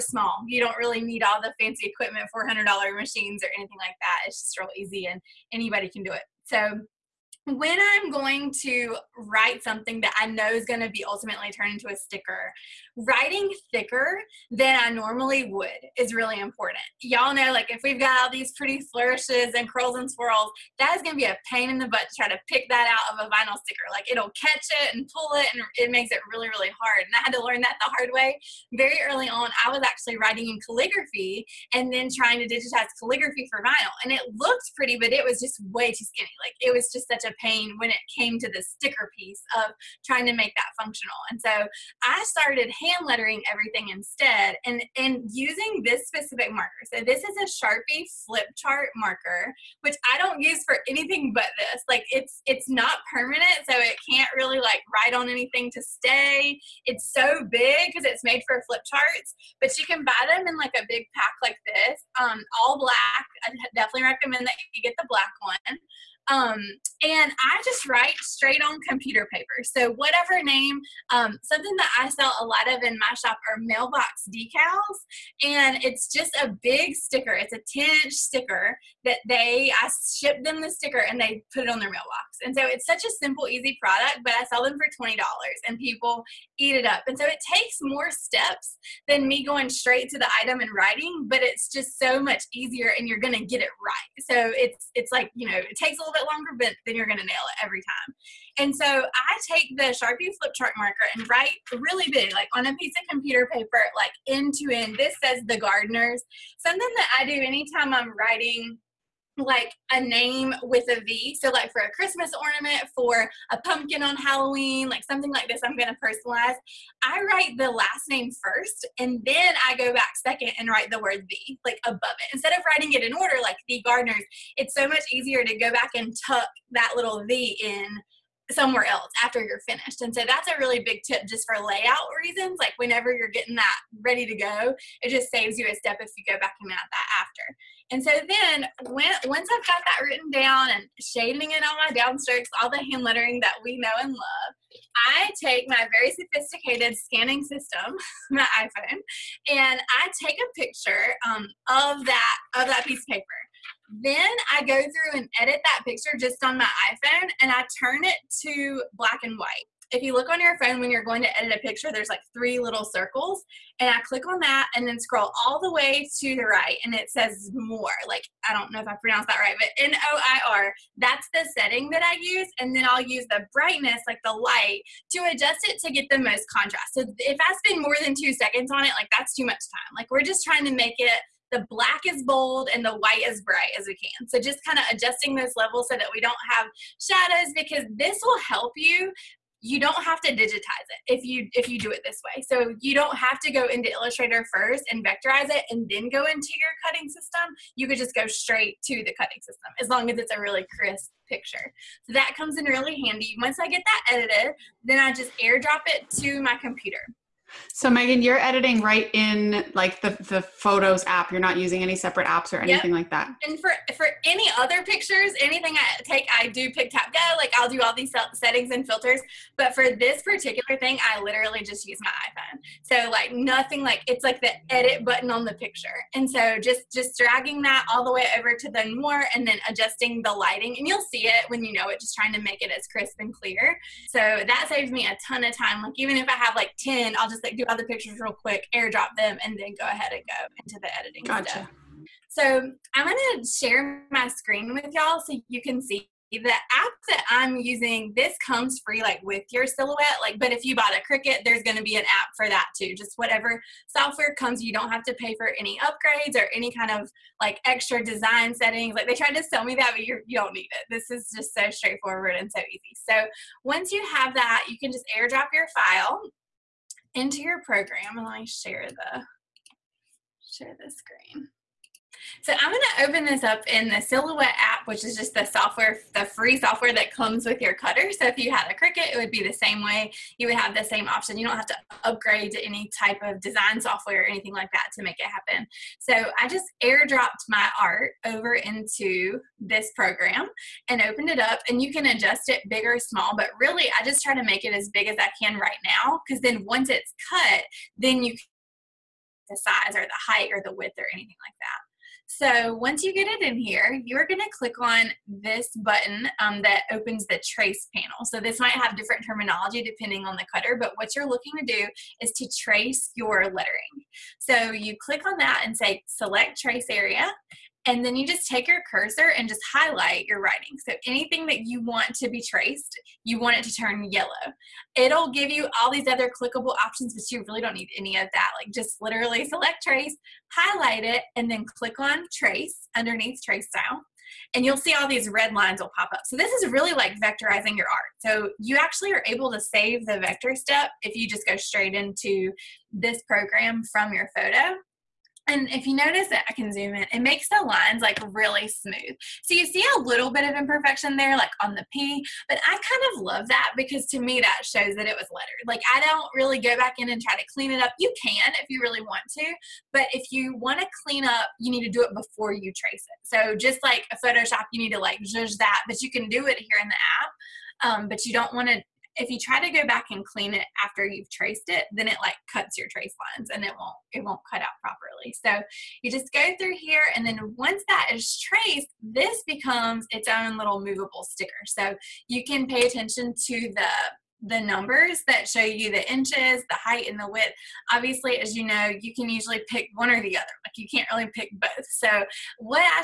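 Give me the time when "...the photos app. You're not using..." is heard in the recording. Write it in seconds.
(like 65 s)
210 s.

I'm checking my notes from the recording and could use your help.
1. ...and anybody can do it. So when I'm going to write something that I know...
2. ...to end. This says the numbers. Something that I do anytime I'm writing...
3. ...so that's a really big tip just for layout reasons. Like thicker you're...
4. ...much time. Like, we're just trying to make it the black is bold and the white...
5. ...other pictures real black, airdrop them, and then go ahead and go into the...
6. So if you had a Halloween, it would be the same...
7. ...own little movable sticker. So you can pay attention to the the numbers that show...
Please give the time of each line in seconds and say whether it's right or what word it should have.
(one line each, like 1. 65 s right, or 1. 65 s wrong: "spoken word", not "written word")
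1. 5 s right
2. 104 s wrong: "gardeners", not "numbers"
3. 130 s wrong: "whenever", not "thicker"
4. 179 s right
5. 237 s wrong: "quick", not "black"
6. 278 s wrong: "Cricut", not "Halloween"
7. 380 s right.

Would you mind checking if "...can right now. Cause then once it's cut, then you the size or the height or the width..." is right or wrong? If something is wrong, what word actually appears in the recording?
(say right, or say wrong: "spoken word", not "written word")
right.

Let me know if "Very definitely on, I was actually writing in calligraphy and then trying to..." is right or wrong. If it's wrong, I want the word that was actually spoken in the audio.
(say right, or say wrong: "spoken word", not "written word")
wrong: "early", not "definitely".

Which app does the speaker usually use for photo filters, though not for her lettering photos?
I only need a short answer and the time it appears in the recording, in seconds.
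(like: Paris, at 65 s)
PicTapGo, at 216 s.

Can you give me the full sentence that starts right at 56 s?
It's so big because it's made for flip charts, but you can buy them in like a big pack like this.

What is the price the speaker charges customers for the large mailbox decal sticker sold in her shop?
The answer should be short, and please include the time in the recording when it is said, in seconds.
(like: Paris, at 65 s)
$20, at 84 s.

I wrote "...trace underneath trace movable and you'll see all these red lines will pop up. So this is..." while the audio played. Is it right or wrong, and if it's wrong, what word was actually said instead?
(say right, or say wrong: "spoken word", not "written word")
wrong: "style", not "movable".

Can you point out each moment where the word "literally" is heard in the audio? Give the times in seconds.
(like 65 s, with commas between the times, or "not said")
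221 s, 329 s.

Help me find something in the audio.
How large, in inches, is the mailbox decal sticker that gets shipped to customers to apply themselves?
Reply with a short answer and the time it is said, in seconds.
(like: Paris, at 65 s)
10 inch, at 77 s.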